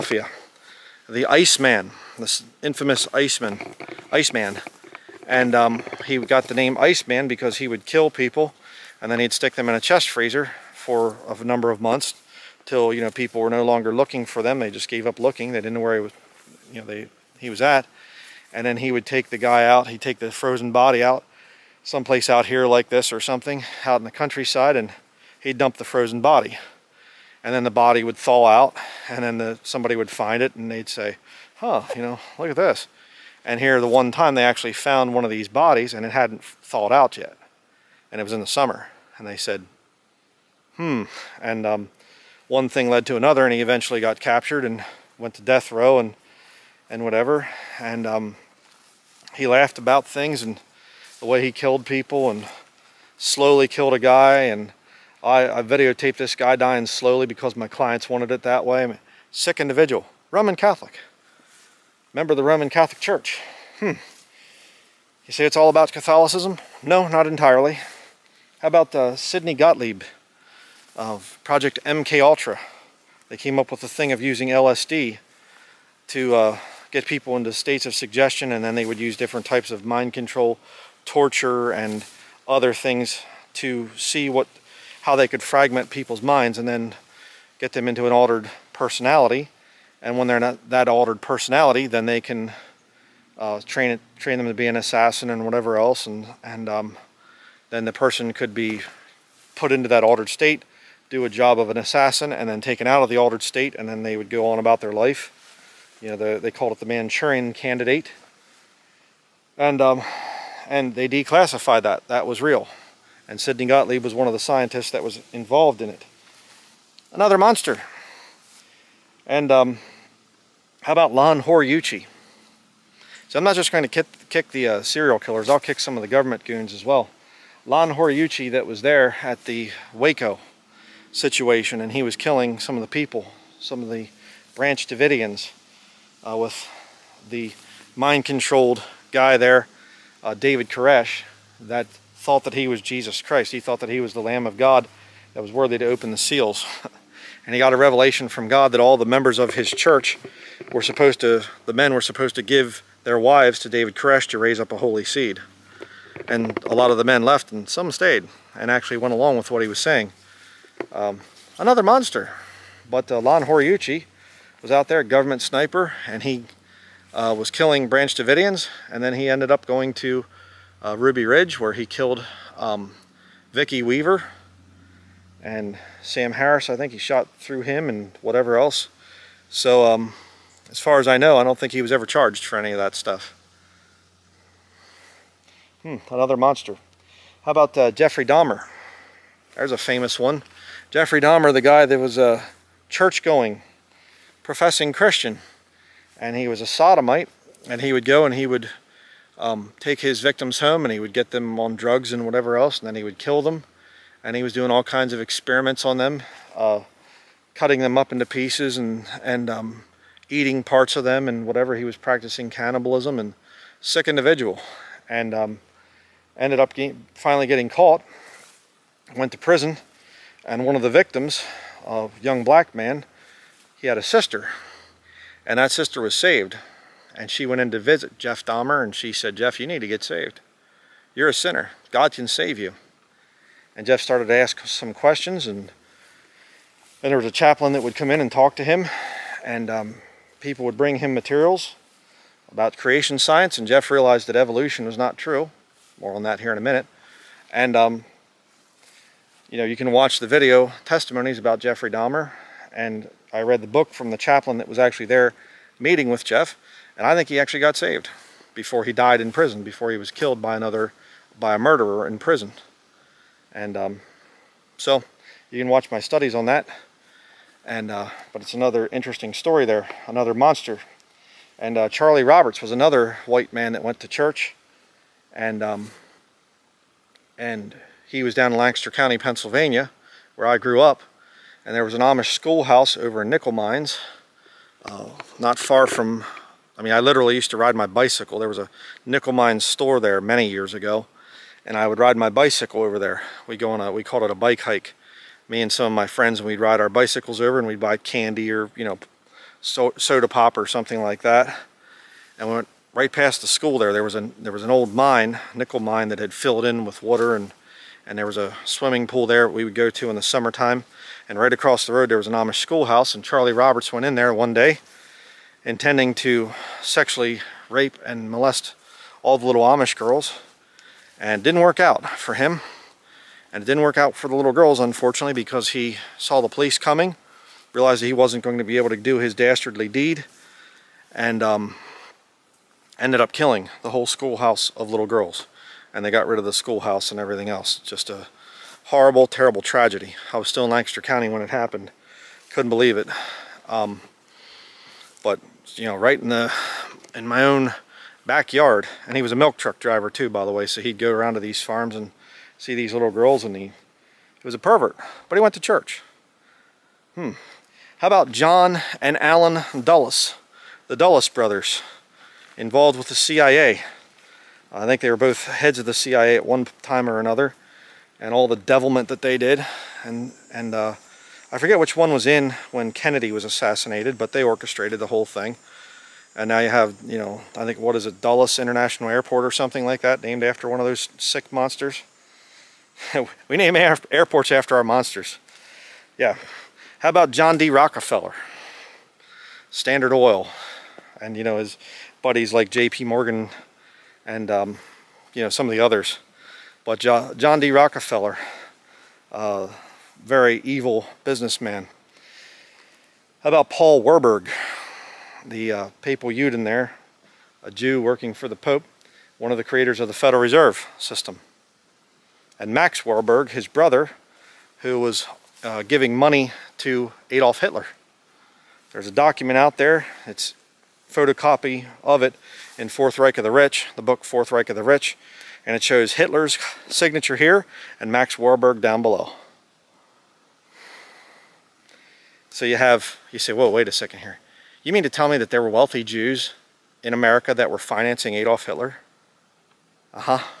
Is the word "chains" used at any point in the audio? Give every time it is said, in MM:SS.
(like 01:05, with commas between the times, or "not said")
not said.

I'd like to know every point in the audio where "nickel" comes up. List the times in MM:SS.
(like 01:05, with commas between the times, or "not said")
04:43, 04:49, 05:05.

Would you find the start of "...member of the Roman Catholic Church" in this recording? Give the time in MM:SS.
01:02.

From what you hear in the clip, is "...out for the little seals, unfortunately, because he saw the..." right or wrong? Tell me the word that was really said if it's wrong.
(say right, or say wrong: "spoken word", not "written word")
wrong: "girls", not "seals".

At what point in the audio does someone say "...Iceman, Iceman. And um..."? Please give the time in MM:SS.
00:03.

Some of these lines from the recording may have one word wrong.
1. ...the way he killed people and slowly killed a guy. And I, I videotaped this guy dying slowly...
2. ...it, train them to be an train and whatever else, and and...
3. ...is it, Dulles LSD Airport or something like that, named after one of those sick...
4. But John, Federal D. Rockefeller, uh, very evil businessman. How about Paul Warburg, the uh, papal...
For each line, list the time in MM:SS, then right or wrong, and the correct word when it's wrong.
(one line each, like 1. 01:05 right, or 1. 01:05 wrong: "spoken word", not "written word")
1. 00:51 right
2. 01:33 wrong: "assassin", not "train"
3. 06:17 wrong: "International", not "LSD"
4. 06:36 wrong: "John", not "Federal".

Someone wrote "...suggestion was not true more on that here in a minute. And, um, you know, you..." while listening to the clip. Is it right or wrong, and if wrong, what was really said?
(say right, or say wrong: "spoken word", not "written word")
wrong: "evolution", not "suggestion".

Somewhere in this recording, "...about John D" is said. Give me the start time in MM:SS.
06:27.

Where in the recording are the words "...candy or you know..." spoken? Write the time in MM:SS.
04:57.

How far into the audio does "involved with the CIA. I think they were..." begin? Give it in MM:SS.
06:02.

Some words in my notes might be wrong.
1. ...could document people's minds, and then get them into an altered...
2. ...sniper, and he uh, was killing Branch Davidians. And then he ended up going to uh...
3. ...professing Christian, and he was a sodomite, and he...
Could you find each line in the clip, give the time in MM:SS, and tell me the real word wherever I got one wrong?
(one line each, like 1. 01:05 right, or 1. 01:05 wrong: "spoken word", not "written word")
1. 01:25 wrong: "fragment", not "document"
2. 02:45 right
3. 03:14 right.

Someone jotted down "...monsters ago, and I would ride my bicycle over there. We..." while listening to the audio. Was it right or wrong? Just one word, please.
wrong.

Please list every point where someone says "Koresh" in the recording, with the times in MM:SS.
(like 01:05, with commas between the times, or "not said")
02:20, 02:33.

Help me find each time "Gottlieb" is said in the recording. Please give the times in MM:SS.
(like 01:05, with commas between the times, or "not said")
01:09, 01:53.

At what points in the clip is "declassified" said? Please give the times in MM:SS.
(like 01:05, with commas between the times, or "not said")
01:51.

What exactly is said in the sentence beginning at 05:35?
And they got rid of the schoolhouse and everything else.